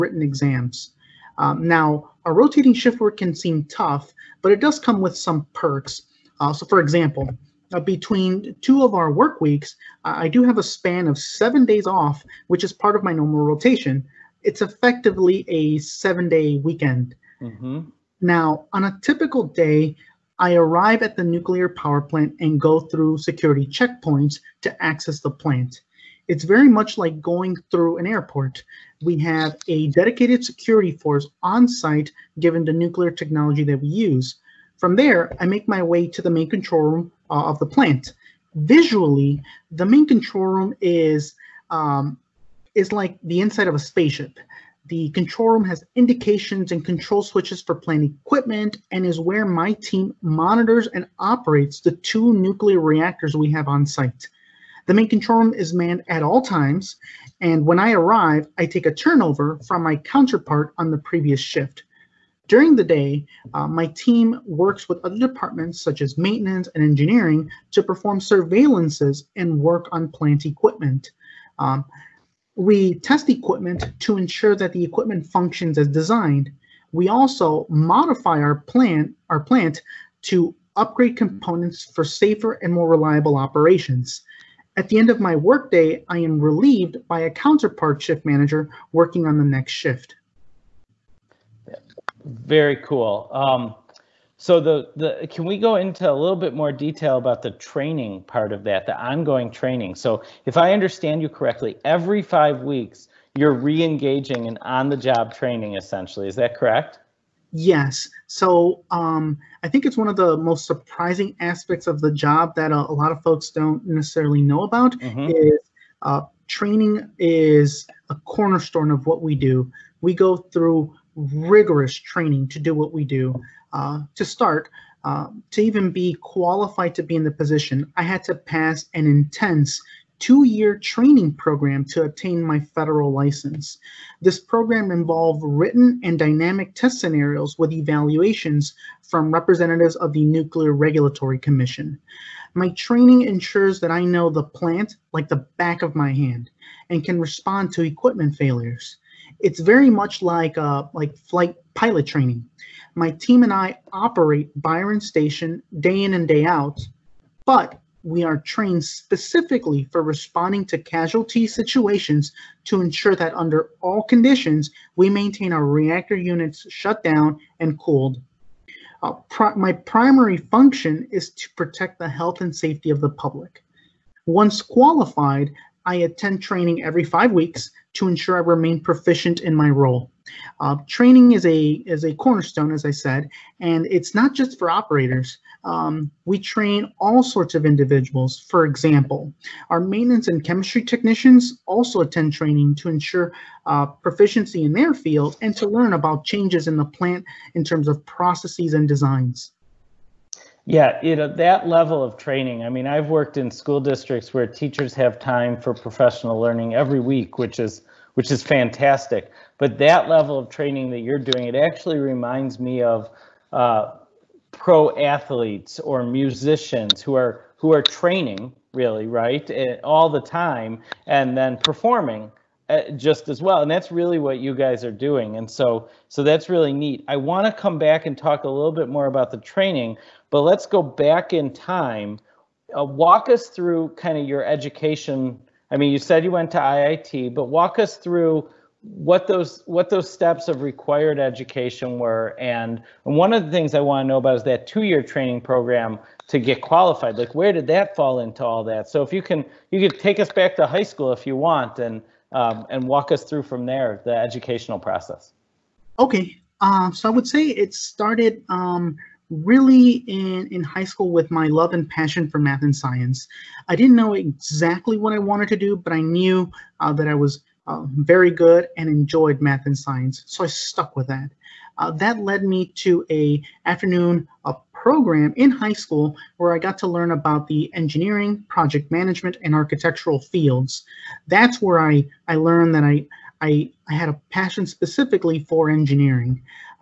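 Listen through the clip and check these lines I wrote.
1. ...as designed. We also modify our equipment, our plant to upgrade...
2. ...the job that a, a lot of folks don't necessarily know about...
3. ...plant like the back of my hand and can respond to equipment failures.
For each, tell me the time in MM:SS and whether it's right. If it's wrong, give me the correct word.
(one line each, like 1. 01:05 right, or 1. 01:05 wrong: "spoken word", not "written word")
1. 01:15 wrong: "plant", not "equipment"
2. 01:51 right
3. 02:24 right.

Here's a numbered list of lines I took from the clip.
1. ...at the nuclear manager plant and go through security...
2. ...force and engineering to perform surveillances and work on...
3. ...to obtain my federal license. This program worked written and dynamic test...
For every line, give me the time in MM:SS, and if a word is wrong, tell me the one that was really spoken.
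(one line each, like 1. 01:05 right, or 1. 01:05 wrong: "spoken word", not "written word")
1. 00:21 wrong: "power", not "manager"
2. 01:06 wrong: "maintenance", not "force"
3. 02:11 wrong: "involved", not "worked".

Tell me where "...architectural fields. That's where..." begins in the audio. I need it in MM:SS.
04:39.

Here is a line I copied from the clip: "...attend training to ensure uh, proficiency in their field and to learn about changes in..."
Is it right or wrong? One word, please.
right.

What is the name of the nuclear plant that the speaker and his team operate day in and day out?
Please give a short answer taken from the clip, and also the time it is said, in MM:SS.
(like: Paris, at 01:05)
Byron Station, at 02:34.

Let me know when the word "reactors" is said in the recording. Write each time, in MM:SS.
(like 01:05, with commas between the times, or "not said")
00:52, 02:45.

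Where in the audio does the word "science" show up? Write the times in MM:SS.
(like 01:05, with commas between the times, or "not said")
04:22, 04:29.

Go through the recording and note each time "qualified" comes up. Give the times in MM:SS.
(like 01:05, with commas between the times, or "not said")
02:06, 02:54, 04:06.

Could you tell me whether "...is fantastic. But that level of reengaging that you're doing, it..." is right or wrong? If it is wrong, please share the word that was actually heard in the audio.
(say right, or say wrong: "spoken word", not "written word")
wrong: "training", not "reengaging".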